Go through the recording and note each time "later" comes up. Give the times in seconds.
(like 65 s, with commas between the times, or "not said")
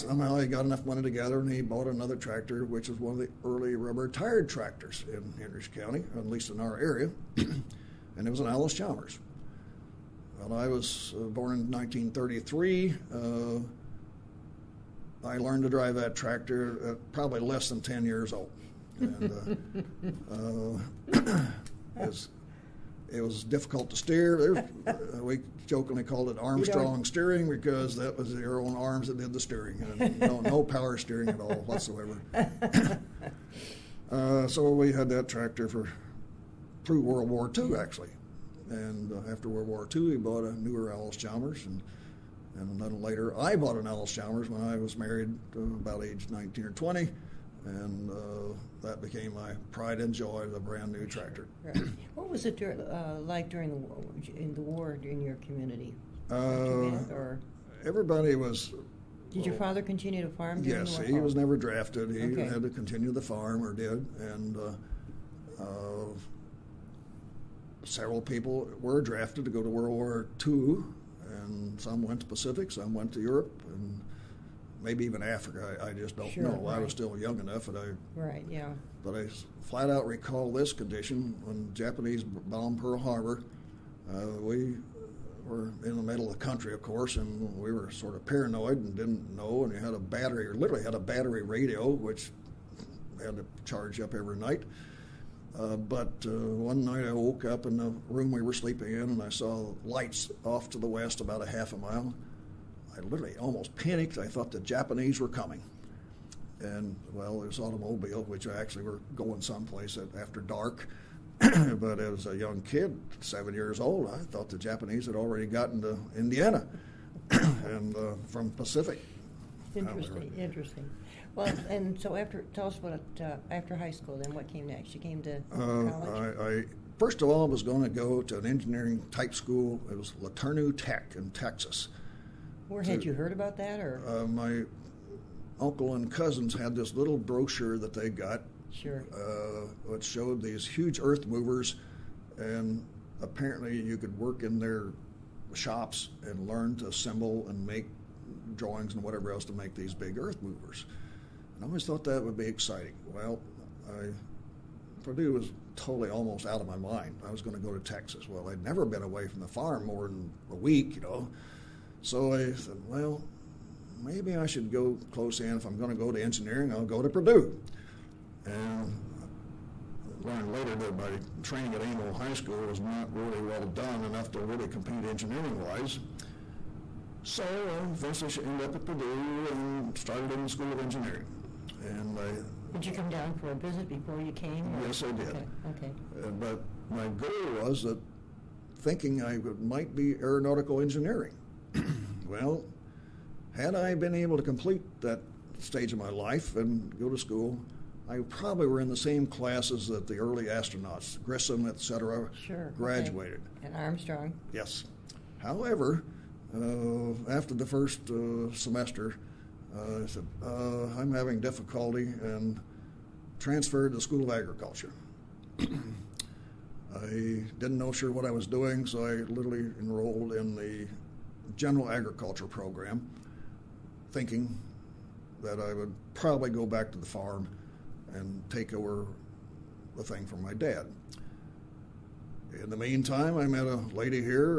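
43 s, 170 s.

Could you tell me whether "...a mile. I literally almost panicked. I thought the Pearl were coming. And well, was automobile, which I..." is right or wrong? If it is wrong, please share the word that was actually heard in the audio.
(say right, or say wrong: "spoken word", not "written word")
wrong: "Japanese", not "Pearl".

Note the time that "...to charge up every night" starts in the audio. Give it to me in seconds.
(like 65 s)
93 s.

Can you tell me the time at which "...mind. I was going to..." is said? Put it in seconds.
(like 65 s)
156 s.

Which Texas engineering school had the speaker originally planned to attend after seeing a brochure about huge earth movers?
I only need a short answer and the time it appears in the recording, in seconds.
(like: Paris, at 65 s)
LeTourneau Tech, at 130 s.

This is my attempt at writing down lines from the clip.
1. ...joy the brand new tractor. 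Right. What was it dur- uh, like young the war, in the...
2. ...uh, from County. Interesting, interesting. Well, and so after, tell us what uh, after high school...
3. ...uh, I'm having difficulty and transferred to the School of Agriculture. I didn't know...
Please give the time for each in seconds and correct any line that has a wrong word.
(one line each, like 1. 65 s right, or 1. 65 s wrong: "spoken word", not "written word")
1. 50 s wrong: "during", not "young"
2. 117 s wrong: "Pacific", not "County"
3. 210 s right.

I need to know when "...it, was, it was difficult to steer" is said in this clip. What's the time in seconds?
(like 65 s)
21 s.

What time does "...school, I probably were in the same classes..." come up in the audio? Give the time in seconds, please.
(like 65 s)
197 s.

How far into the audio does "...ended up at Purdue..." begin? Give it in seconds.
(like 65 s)
178 s.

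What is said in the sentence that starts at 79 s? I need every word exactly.
But I flat out recall this condition when Japanese bombed Pearl Harbor.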